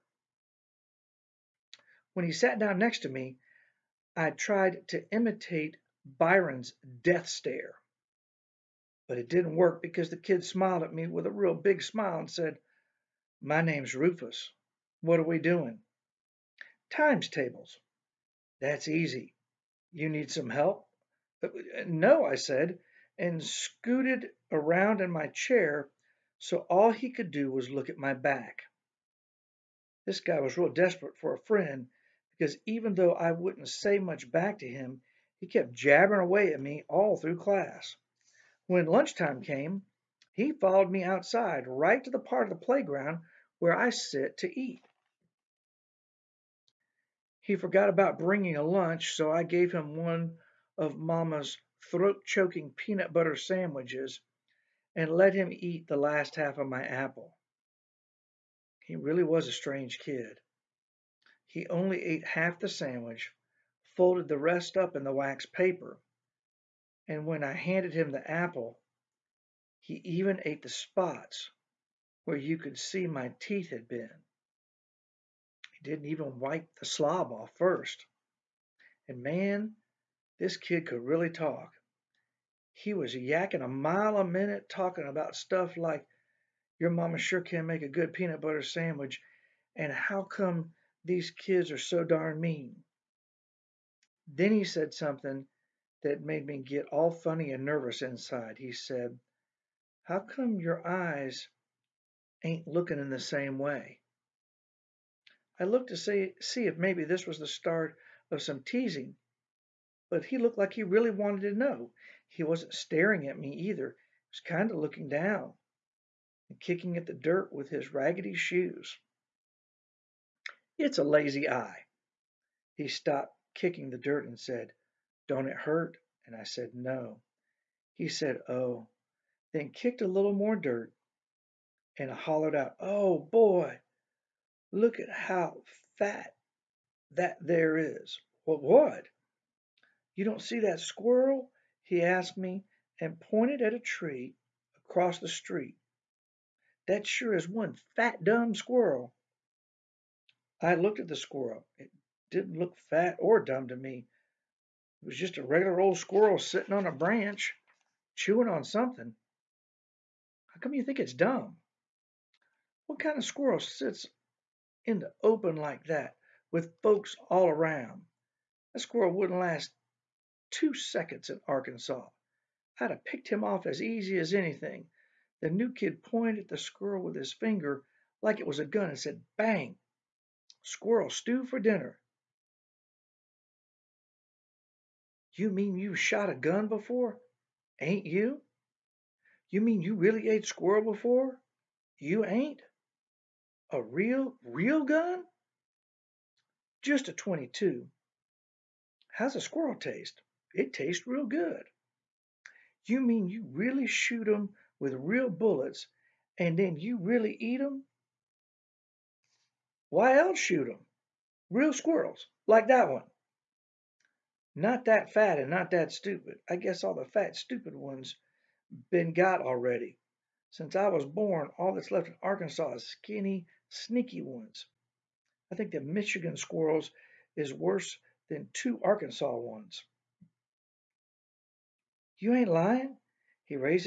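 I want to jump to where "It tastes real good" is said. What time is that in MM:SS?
03:20.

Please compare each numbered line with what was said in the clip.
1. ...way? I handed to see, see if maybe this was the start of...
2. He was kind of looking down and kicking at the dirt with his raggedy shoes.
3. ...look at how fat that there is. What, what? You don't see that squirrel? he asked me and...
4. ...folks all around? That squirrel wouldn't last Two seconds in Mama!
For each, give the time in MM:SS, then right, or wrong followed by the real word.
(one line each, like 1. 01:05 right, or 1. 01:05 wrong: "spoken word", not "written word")
1. 01:43 wrong: "looked", not "handed"
2. 01:53 right
3. 02:14 right
4. 02:46 wrong: "Arkansas", not "Mama".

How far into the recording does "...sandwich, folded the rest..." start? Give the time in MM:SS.
01:02.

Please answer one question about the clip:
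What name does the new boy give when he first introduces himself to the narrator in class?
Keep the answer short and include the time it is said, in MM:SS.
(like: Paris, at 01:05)
Rufus, at 00:13.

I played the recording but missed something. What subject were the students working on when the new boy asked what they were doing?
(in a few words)
Times tables.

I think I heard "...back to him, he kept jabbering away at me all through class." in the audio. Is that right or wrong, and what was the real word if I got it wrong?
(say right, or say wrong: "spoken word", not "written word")
right.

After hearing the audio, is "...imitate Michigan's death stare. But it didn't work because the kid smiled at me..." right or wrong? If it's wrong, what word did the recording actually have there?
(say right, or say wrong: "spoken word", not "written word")
wrong: "Byron", not "Michigan".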